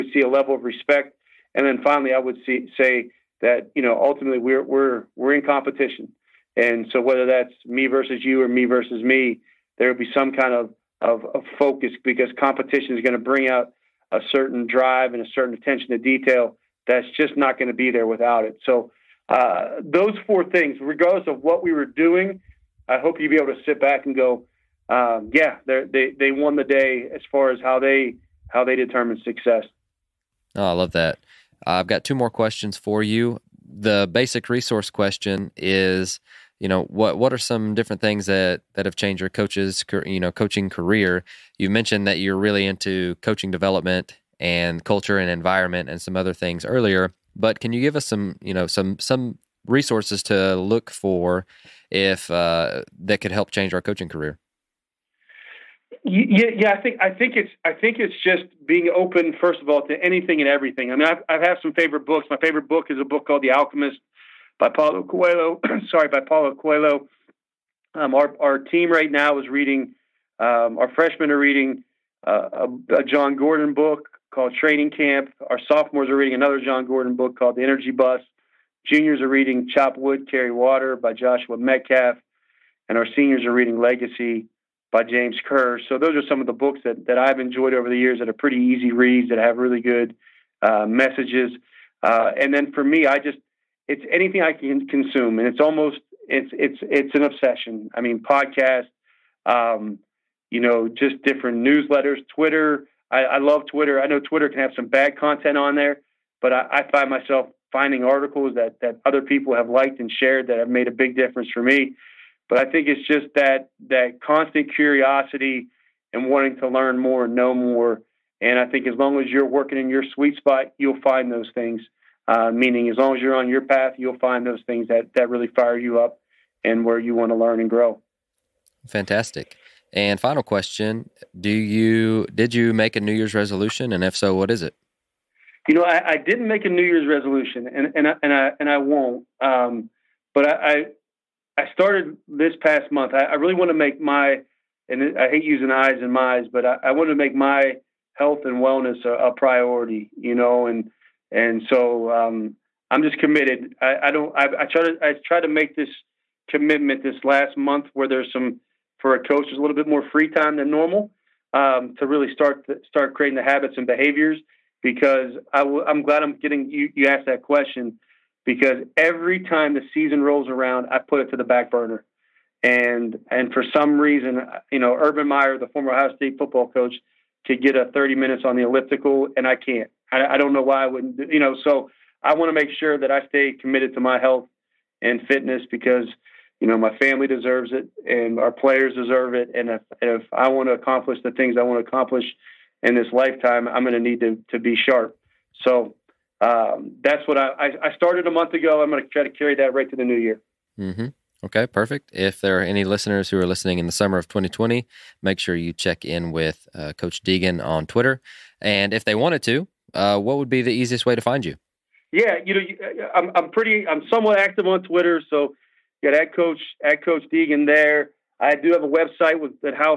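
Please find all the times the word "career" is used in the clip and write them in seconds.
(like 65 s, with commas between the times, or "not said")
40 s, 54 s.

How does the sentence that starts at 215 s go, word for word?
So got head coach head coach Deegan there.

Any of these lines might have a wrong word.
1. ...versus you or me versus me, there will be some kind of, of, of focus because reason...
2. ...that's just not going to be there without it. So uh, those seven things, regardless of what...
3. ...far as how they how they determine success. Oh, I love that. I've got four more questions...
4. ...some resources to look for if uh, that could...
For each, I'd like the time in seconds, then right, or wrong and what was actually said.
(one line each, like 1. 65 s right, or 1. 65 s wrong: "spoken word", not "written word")
1. 7 s wrong: "competition", not "reason"
2. 16 s wrong: "four", not "seven"
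3. 27 s wrong: "two", not "four"
4. 48 s right.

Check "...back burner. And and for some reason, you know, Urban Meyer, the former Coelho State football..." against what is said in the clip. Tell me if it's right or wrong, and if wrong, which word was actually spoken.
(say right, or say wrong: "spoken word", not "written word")
wrong: "Ohio", not "Coelho".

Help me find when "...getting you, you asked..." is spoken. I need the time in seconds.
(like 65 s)
166 s.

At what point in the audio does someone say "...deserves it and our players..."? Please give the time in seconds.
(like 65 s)
187 s.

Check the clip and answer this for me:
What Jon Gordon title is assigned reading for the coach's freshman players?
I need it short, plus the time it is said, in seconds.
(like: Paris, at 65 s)
Training Camp, at 74 s.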